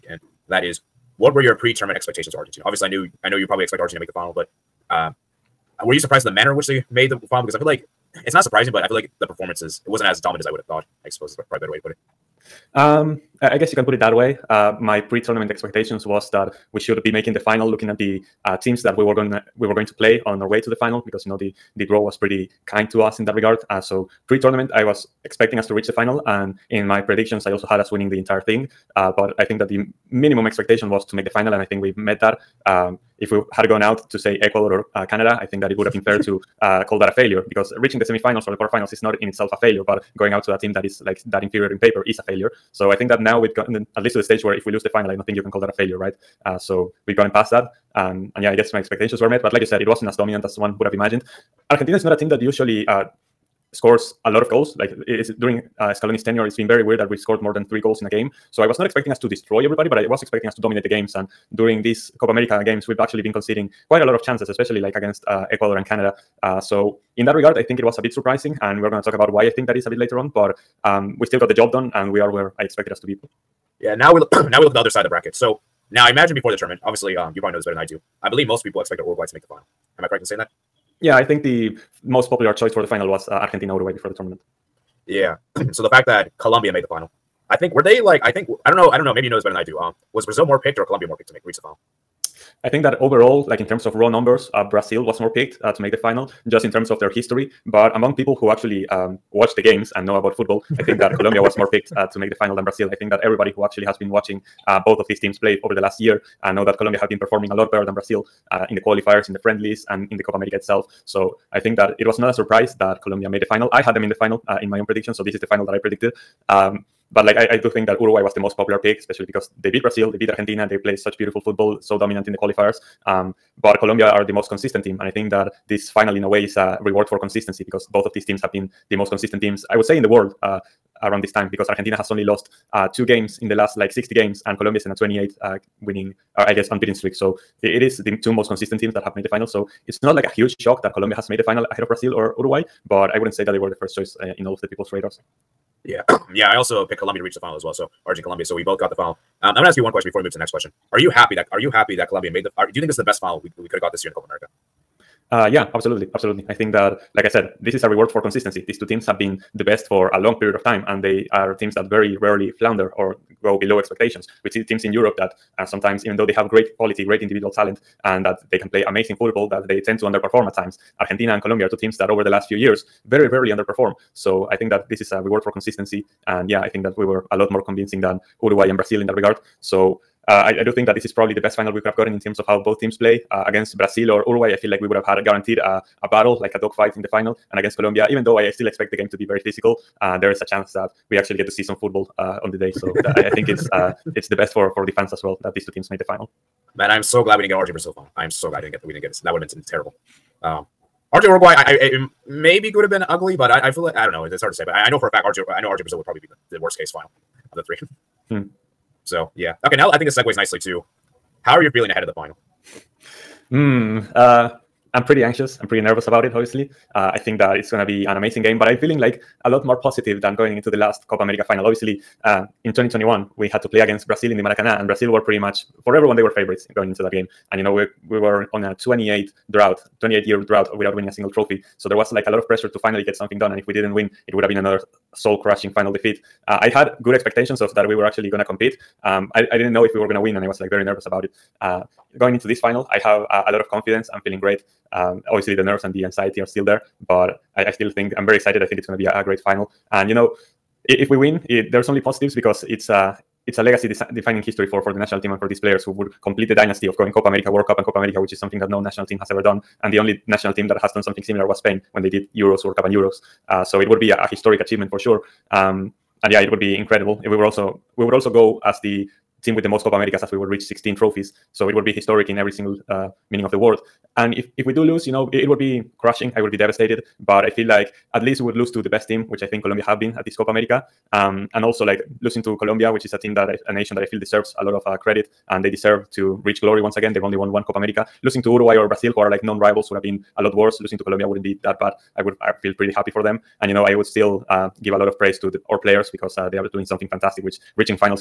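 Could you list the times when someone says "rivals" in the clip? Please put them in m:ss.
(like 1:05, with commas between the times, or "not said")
4:49.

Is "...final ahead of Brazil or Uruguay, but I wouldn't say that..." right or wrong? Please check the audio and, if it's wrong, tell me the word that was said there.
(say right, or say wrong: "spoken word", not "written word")
right.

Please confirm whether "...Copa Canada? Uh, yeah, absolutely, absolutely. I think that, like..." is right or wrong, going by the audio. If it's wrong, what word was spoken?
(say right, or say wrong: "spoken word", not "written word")
wrong: "America", not "Canada".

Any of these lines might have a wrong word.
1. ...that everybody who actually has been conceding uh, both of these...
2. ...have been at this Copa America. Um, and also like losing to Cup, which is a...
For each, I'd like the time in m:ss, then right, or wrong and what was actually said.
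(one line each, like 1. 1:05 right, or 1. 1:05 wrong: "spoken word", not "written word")
1. 1:43 wrong: "watching", not "conceding"
2. 4:39 wrong: "Colombia", not "Cup".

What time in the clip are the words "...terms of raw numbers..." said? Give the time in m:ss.
1:33.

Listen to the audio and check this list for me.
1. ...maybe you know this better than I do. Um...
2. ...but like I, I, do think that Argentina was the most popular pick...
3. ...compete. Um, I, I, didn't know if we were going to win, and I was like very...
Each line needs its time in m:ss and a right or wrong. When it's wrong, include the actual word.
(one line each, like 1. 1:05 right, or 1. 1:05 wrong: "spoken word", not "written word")
1. 1:29 right
2. 1:57 wrong: "Uruguay", not "Argentina"
3. 3:58 right.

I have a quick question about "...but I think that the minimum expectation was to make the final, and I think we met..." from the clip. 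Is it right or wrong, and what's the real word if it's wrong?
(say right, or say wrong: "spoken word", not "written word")
right.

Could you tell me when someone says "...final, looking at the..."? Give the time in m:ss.
0:17.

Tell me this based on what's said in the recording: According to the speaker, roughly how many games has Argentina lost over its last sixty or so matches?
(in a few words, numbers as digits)
2.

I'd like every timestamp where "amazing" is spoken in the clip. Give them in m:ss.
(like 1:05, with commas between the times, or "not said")
2:48, 3:38.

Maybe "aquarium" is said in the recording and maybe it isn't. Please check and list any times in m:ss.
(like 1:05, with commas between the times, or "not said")
not said.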